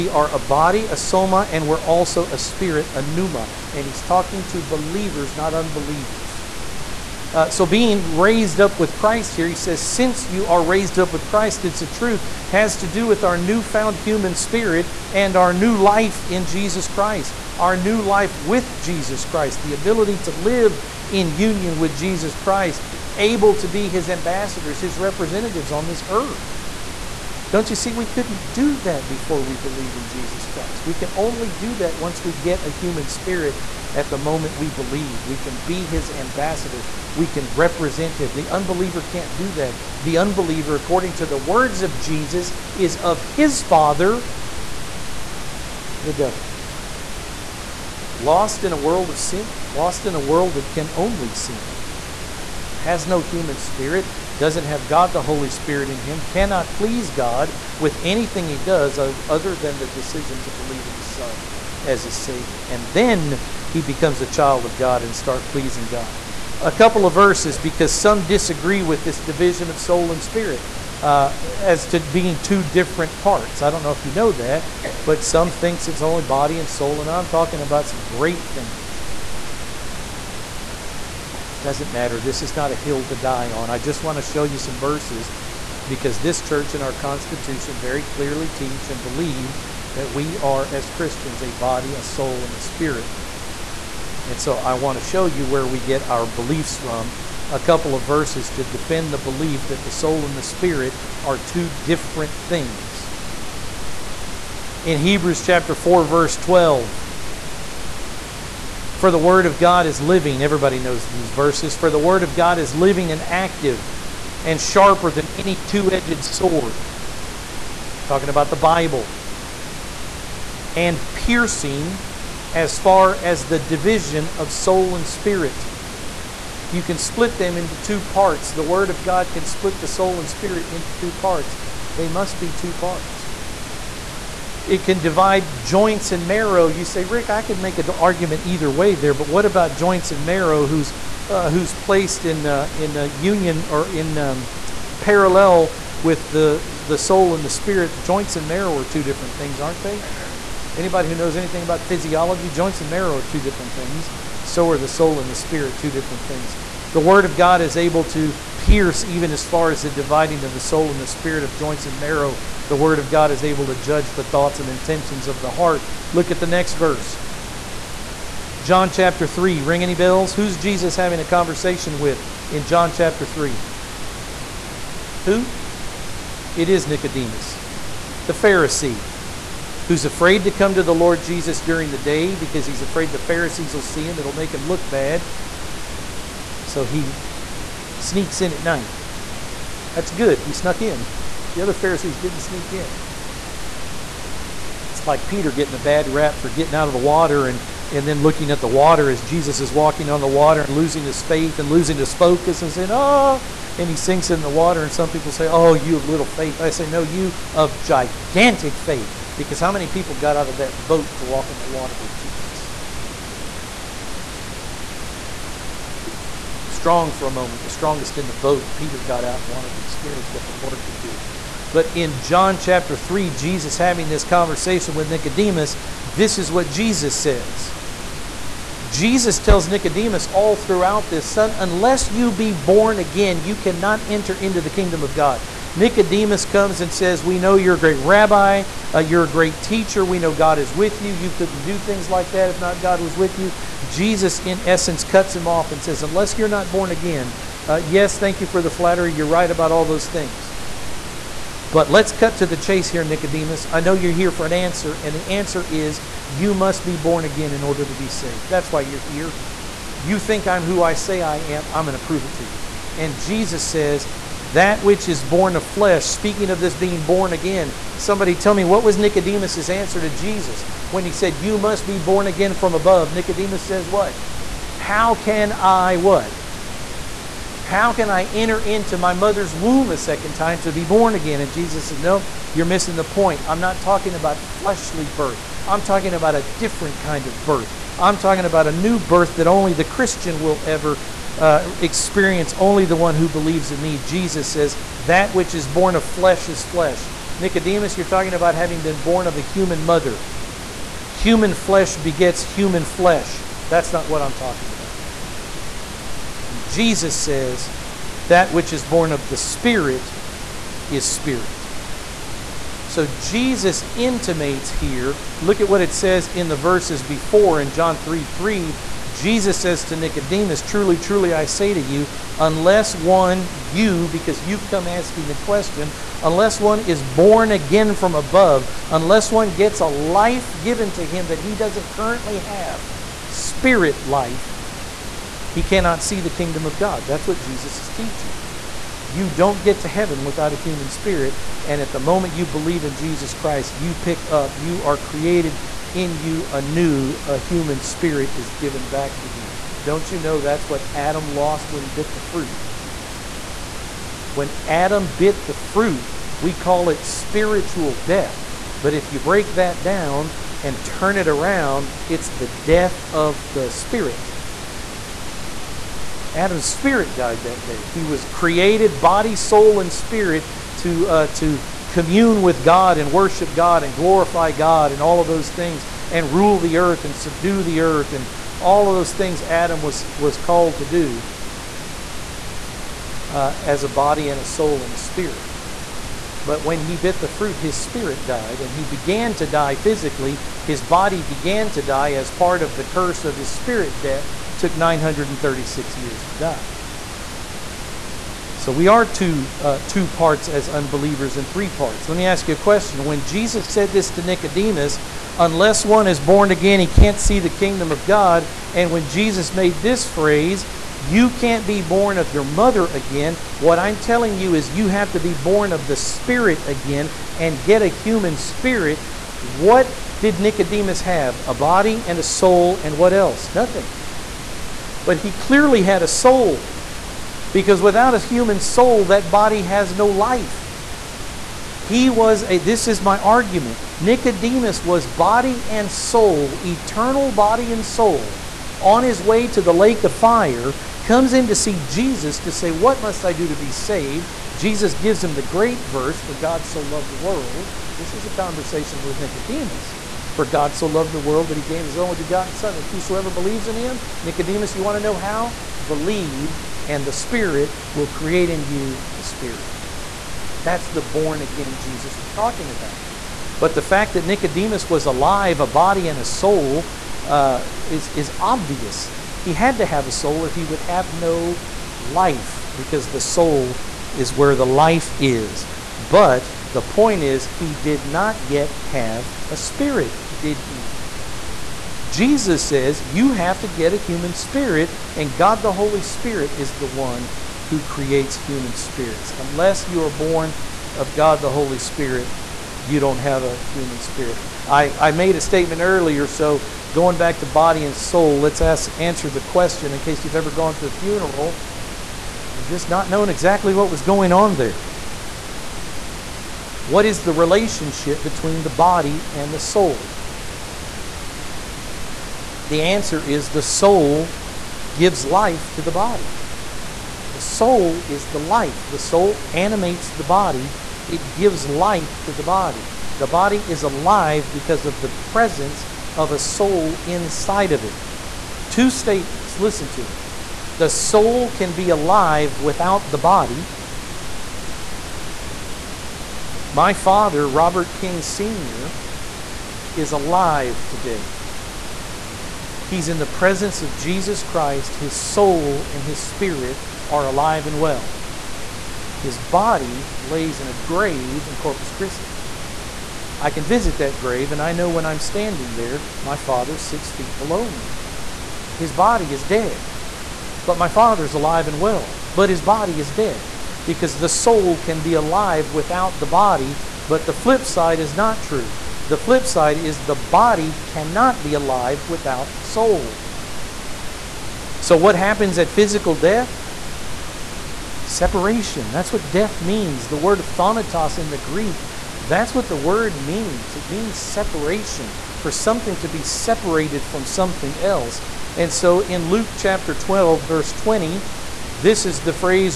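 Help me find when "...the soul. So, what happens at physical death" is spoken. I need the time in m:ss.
9:32.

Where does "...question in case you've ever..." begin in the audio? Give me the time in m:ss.
8:19.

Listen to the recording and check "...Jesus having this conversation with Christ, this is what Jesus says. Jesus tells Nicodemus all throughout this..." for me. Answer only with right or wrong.
wrong.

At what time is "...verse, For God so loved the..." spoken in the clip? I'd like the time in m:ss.
7:25.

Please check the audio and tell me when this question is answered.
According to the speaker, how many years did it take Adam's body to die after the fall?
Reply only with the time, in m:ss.
6:34.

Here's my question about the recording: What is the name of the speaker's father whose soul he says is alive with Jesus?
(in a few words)
Robert King Sr.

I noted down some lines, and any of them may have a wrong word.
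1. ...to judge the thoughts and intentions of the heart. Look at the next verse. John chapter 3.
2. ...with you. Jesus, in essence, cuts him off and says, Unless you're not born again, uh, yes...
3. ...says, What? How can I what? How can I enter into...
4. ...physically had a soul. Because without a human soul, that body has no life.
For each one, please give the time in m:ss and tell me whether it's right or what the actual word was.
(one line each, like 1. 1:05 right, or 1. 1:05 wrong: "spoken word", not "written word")
1. 2:43 right
2. 4:03 right
3. 4:33 right
4. 7:05 wrong: "clearly", not "physically".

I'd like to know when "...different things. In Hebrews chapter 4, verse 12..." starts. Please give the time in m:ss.
1:41.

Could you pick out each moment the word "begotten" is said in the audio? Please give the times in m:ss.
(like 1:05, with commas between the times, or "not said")
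7:32.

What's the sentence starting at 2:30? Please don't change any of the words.
Anybody who knows anything about physiology, joints and marrow are two different things.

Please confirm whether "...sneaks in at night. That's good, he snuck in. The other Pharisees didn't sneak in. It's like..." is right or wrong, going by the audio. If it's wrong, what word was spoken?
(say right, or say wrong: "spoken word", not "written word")
right.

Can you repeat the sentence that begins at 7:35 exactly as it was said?
Believe, and the Spirit will create in you a spirit.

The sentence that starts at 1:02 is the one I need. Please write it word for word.
And then he becomes a child of God and start pleasing God.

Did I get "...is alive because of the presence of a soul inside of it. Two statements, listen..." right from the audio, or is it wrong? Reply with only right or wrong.
right.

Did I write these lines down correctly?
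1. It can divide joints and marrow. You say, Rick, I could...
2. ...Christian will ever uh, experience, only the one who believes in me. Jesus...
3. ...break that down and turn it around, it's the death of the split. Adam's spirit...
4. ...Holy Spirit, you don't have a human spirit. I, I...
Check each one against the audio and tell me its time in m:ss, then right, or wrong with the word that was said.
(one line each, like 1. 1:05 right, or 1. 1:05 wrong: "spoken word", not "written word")
1. 2:14 right
2. 4:49 right
3. 5:59 wrong: "spirit", not "split"
4. 8:11 right.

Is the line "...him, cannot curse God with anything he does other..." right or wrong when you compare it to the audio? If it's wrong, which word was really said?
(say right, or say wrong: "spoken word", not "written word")
wrong: "please", not "curse".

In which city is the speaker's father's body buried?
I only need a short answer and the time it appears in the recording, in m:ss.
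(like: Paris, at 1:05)
Corpus Christi, at 9:11.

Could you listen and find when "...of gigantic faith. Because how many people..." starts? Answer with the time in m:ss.
3:27.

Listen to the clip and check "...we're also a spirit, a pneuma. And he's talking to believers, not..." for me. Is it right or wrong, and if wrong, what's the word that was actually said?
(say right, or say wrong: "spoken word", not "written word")
right.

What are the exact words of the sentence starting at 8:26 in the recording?
What is the relationship between the body and the soul?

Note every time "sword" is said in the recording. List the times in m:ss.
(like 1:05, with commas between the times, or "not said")
1:56.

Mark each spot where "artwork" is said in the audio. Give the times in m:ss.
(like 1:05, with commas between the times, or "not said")
not said.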